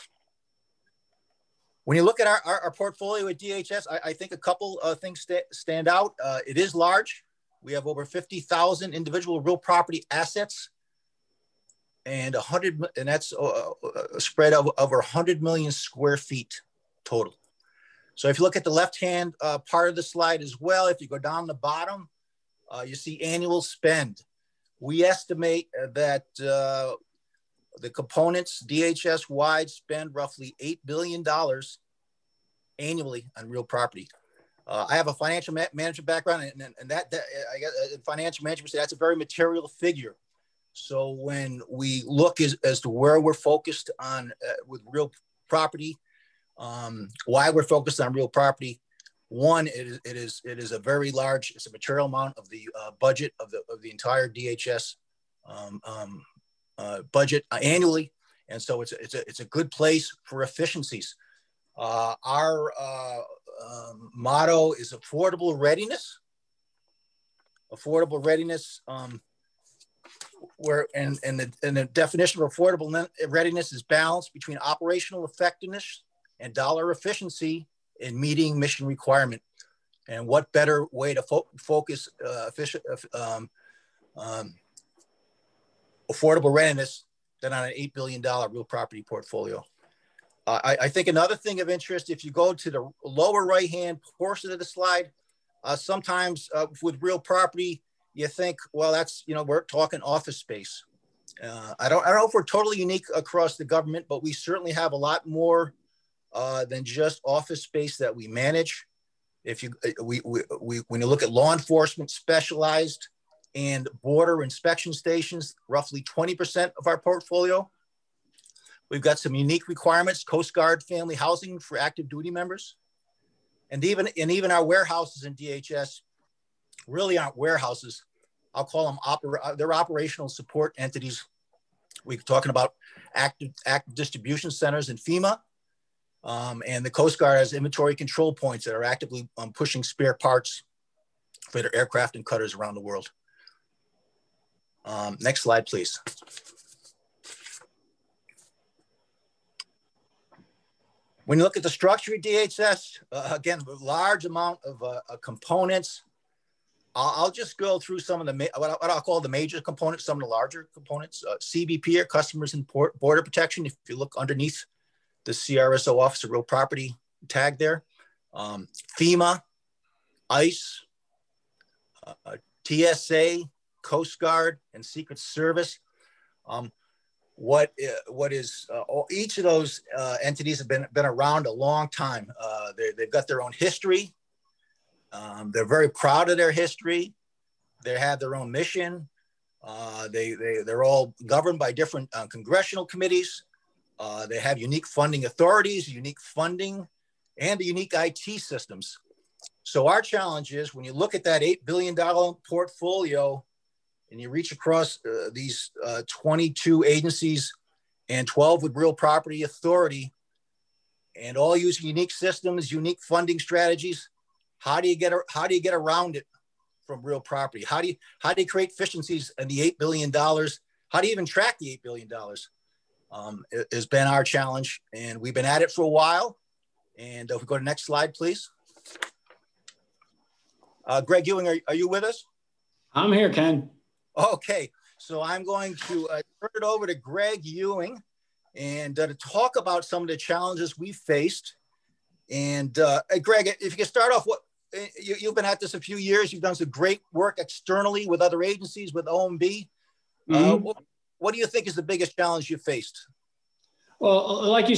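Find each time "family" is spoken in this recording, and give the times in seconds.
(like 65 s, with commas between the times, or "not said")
120 s.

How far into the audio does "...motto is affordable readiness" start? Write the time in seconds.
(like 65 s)
64 s.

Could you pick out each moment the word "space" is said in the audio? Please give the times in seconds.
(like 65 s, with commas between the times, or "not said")
100 s, 107 s.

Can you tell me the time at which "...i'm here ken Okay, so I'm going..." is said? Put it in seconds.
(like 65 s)
232 s.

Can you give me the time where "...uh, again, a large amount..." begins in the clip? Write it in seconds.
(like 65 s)
153 s.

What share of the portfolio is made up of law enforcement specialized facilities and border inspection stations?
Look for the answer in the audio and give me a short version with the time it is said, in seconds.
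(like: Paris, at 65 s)
20%, at 116 s.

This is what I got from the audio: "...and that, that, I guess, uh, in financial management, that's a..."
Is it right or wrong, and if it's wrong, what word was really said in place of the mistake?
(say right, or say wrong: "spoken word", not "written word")
right.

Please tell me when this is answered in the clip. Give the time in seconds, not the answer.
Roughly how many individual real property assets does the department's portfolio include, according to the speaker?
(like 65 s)
7 s.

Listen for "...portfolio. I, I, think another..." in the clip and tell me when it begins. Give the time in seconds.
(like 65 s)
89 s.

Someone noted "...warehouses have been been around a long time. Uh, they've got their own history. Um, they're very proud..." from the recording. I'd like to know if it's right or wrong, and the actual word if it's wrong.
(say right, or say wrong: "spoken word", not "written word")
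wrong: "entities", not "warehouses".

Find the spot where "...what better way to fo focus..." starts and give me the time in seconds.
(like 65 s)
80 s.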